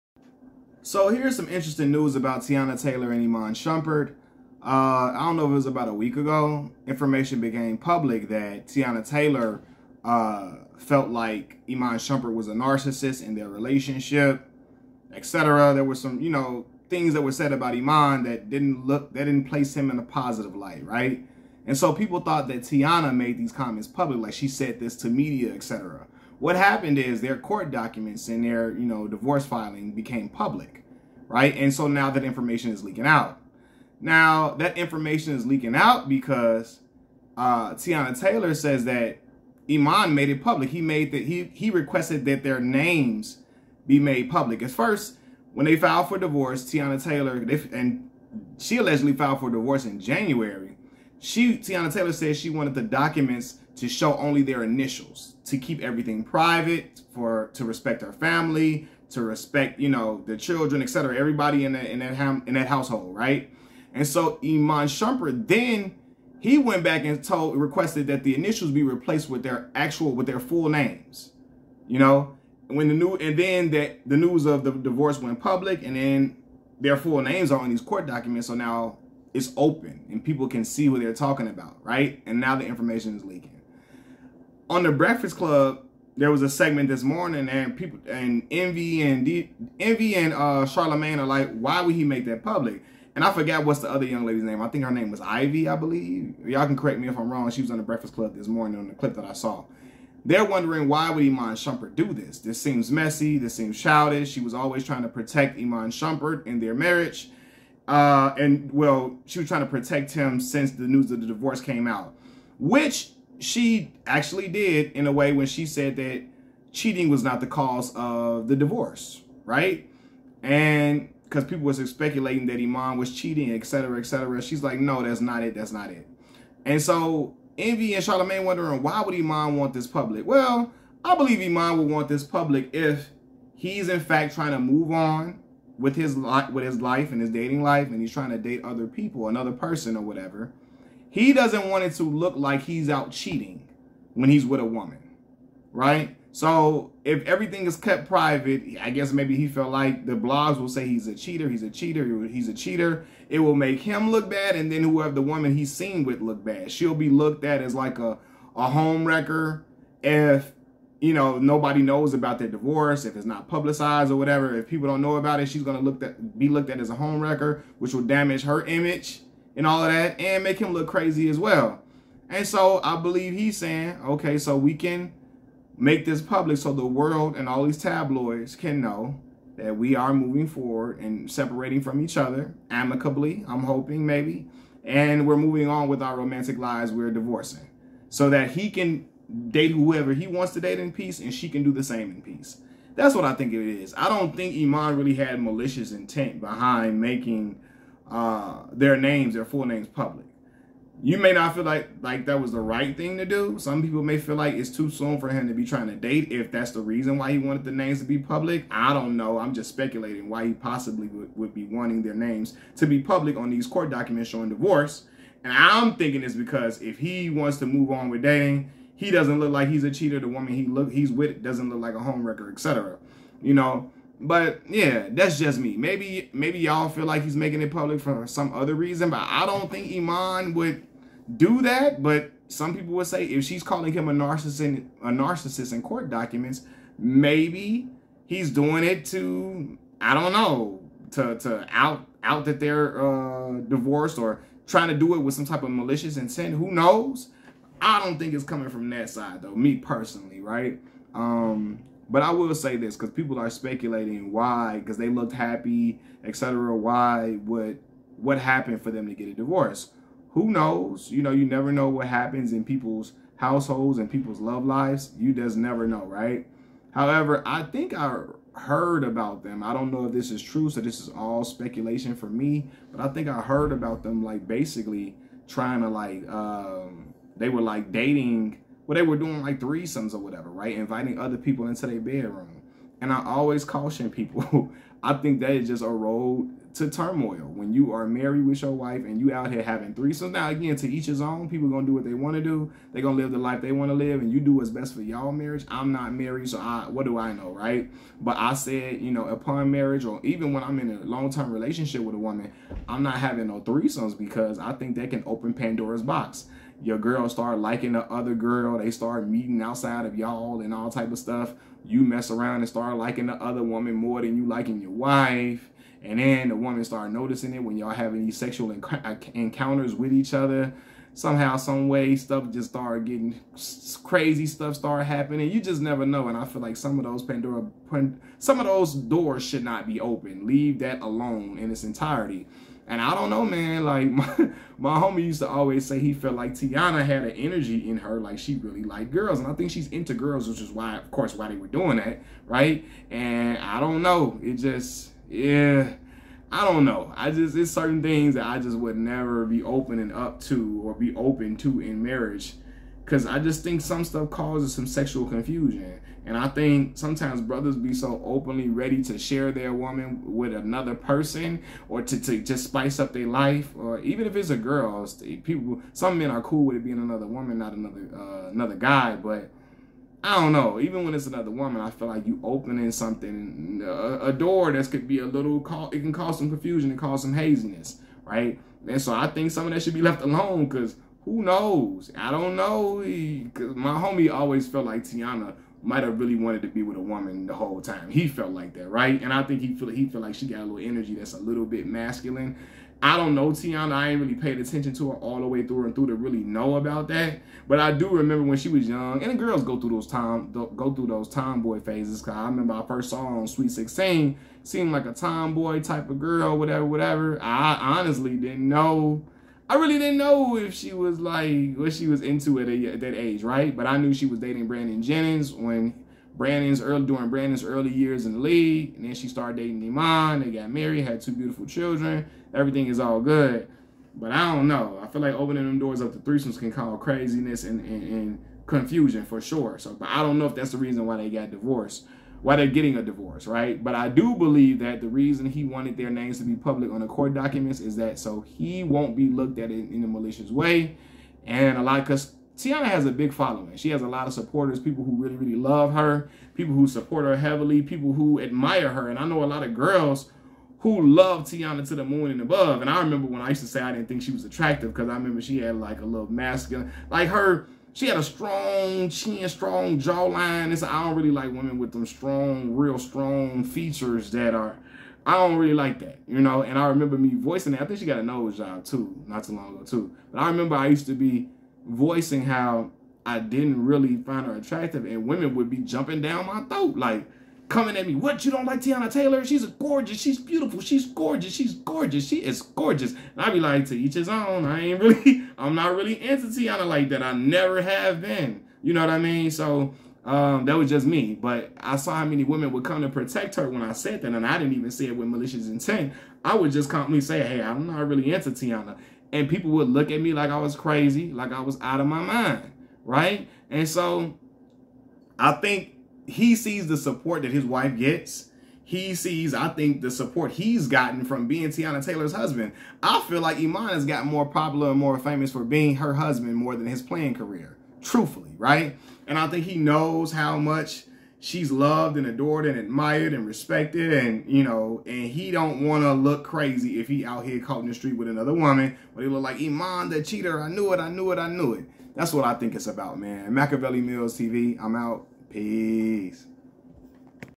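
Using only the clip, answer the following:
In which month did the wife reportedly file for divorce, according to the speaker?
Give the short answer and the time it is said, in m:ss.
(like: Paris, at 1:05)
January, at 0:49.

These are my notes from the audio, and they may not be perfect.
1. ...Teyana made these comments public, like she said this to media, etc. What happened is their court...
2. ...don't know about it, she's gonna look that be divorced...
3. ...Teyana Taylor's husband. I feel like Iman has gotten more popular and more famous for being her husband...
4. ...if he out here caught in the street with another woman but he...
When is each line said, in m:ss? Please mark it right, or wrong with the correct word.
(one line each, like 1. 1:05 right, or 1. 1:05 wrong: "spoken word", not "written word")
1. 0:22 right
2. 2:44 wrong: "looked", not "divorced"
3. 8:31 right
4. 8:46 right.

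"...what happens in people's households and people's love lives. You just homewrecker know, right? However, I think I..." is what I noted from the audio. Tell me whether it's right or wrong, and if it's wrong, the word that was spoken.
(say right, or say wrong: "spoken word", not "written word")
wrong: "never", not "homewrecker".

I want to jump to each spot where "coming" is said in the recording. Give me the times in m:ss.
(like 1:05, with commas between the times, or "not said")
4:08, 7:57.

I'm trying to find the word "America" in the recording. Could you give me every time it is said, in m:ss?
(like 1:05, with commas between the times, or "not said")
not said.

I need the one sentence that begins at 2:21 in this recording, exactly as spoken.
He doesn't want it to look like he's out cheating when he's with a woman, right?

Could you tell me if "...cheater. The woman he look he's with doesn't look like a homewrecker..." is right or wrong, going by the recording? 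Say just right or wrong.
right.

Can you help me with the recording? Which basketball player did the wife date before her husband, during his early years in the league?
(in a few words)
Brandon Jennings.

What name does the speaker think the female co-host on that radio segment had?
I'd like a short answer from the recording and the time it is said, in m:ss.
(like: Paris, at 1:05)
Ivy, at 1:35.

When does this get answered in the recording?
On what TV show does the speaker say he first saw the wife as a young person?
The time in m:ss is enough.
6:43.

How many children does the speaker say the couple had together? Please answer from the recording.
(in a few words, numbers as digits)
2.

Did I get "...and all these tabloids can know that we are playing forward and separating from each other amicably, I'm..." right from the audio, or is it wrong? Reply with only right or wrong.
wrong.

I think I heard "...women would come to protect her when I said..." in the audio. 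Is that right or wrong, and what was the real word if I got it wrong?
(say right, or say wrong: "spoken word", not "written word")
right.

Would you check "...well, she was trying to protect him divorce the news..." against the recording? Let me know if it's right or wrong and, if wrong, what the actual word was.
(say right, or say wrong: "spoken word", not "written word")
wrong: "since", not "divorce".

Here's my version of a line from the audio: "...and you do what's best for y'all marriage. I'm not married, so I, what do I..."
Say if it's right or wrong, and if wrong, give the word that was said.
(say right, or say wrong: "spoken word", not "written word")
right.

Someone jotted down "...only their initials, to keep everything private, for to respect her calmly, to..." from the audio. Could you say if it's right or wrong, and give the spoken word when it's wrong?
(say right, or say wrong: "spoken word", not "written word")
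wrong: "family", not "calmly".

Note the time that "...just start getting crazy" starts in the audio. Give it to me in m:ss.
5:22.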